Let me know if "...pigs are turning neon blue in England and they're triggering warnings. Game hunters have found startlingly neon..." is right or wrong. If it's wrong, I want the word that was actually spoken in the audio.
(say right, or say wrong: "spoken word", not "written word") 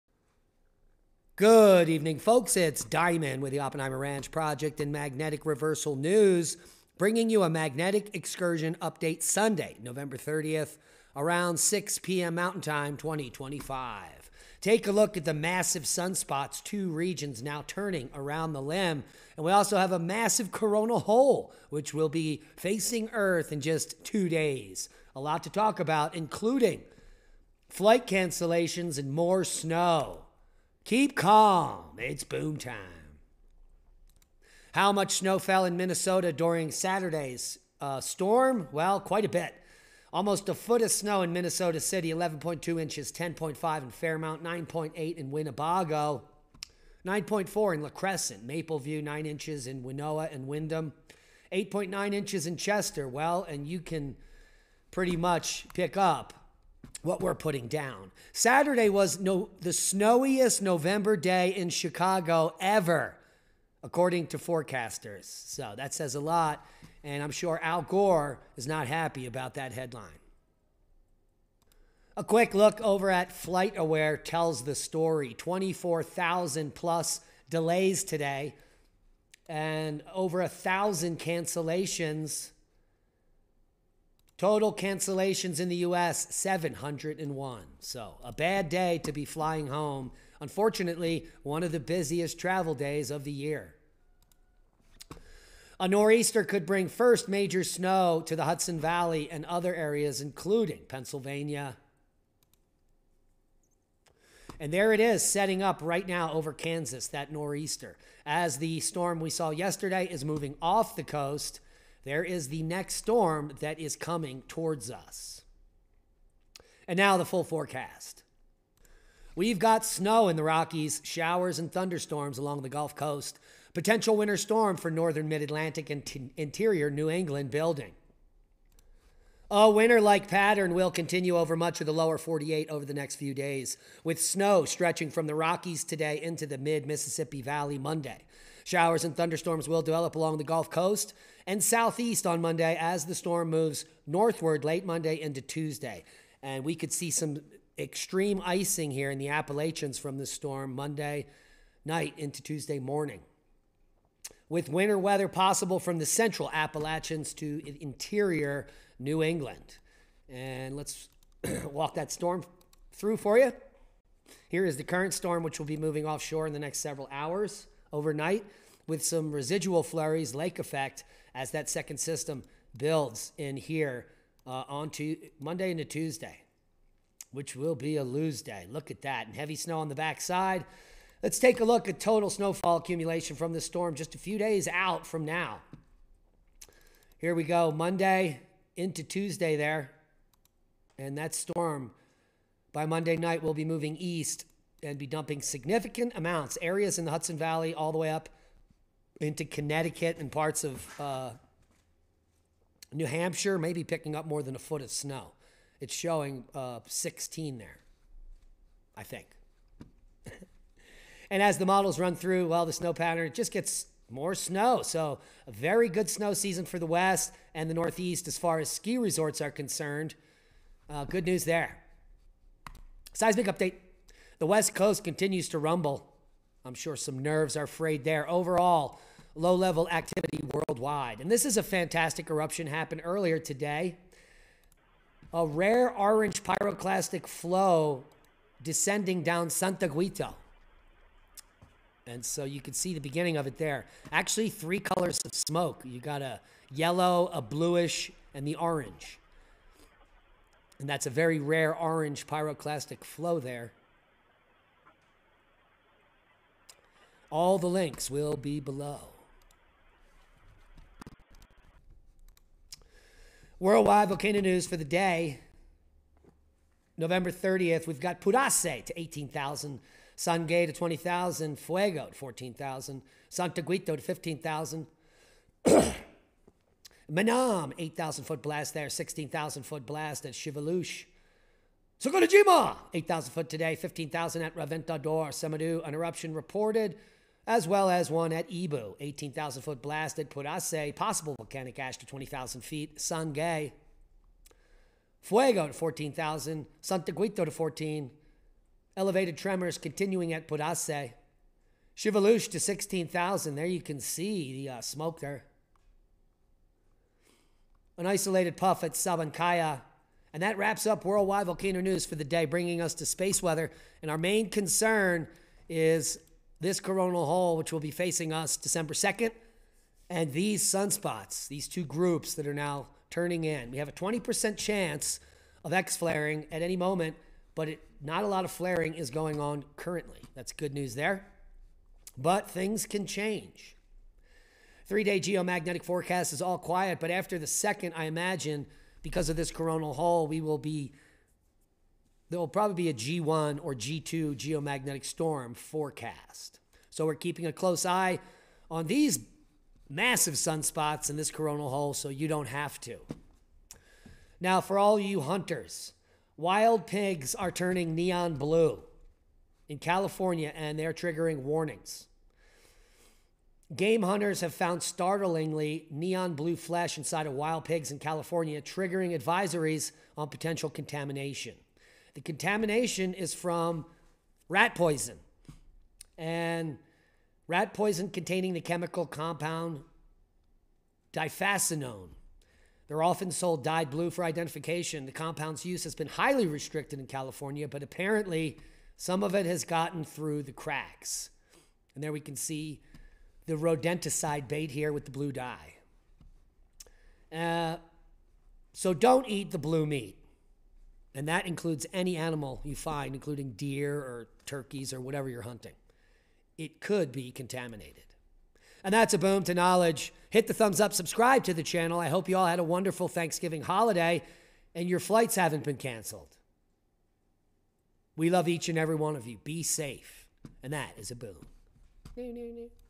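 wrong: "California", not "England".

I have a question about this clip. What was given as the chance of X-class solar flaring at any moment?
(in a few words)
20%.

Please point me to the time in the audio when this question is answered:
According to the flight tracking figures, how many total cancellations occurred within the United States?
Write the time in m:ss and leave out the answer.
1:26.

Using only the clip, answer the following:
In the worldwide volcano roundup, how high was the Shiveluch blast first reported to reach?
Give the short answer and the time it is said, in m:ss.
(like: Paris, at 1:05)
16,000 feet, at 4:38.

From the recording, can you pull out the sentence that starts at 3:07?
Here we go, Monday into Tuesday there.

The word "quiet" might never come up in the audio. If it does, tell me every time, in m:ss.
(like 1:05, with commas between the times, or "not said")
5:36.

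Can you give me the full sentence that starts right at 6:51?
I hope you all had a wonderful Thanksgiving holiday and your flights haven't been canceled.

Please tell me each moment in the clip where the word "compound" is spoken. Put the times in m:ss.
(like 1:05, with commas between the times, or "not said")
6:19, 6:25.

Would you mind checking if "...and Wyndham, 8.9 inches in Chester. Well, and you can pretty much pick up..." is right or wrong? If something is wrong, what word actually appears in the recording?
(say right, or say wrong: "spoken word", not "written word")
right.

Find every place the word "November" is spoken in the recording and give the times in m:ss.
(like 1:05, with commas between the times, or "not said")
0:09, 1:00, 4:26.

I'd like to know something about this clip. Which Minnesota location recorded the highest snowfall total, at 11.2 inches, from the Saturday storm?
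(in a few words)
Minnesota City.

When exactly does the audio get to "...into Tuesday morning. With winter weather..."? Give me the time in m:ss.
2:32.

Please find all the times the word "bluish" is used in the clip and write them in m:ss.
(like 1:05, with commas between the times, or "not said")
4:07.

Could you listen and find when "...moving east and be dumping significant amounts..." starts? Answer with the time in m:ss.
3:13.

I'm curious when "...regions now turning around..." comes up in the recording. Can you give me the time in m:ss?
0:16.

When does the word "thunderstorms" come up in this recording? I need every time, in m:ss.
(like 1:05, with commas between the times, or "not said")
2:01, 2:19.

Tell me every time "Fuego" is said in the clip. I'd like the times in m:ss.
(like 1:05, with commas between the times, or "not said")
4:31, 4:55.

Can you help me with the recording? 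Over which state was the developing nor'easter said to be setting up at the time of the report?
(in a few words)
Kansas.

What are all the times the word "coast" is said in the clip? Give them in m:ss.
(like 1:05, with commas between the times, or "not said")
1:51, 2:02, 2:20, 3:44.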